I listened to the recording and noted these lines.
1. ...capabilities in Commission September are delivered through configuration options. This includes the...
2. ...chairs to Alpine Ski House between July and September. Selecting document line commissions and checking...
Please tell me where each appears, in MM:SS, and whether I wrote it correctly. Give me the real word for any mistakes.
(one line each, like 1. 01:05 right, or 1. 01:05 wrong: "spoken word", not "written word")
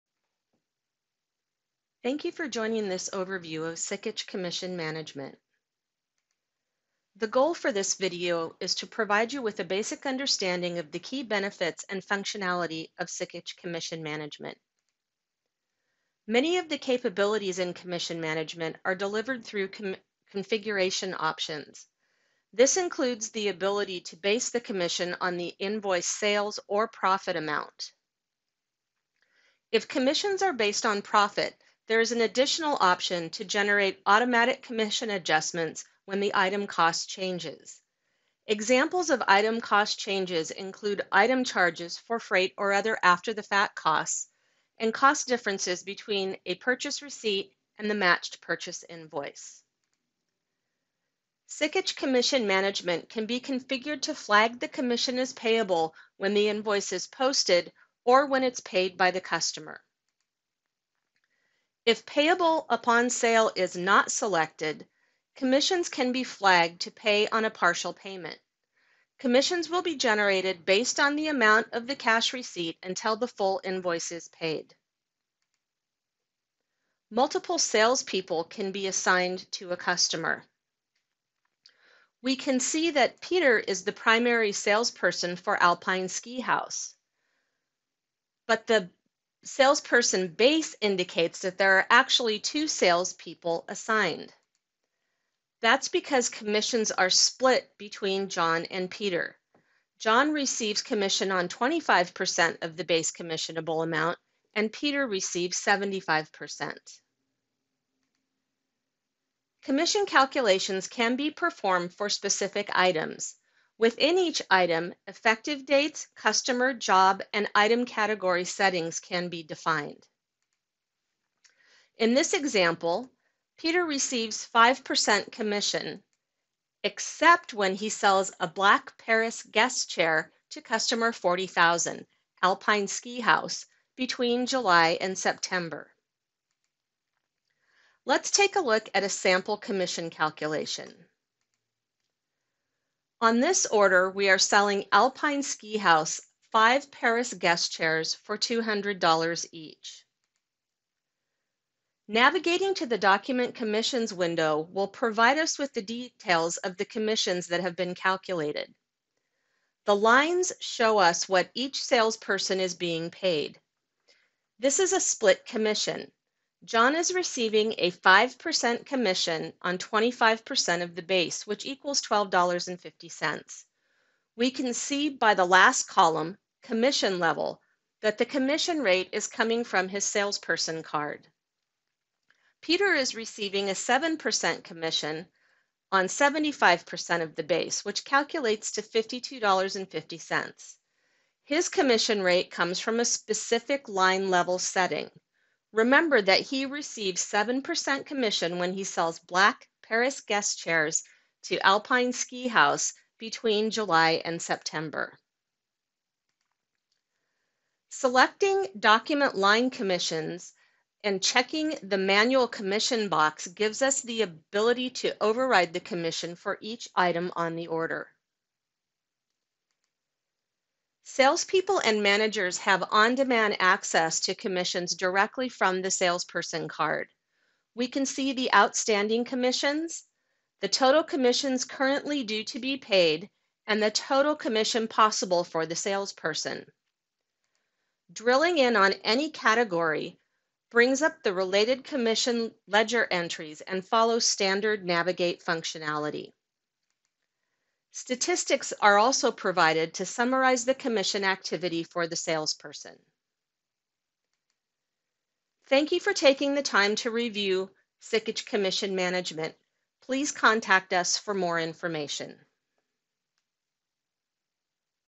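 1. 00:16 wrong: "Management", not "September"
2. 03:20 right.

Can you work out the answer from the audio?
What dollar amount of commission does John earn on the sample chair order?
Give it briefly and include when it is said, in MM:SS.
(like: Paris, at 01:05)
$12.50, at 02:52.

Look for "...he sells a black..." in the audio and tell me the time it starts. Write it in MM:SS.
02:07.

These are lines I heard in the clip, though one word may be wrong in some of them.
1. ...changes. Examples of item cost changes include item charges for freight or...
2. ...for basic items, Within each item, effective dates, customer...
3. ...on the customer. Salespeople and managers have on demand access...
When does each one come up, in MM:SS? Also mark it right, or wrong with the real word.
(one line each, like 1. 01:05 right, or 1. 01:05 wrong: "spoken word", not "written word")
1. 00:37 right
2. 01:51 wrong: "specific", not "basic"
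3. 03:37 wrong: "order", not "customer".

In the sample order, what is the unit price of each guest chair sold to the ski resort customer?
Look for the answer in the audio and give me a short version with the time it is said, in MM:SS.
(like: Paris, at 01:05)
$200, at 02:28.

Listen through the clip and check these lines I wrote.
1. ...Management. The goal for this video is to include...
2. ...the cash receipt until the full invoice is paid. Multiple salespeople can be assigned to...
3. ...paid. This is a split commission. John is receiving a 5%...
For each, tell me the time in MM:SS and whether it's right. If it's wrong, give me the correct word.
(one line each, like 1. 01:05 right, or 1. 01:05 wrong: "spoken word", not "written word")
1. 00:04 wrong: "provide", not "include"
2. 01:11 right
3. 02:43 right.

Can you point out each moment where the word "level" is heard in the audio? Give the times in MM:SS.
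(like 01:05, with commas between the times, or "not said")
02:57, 03:14.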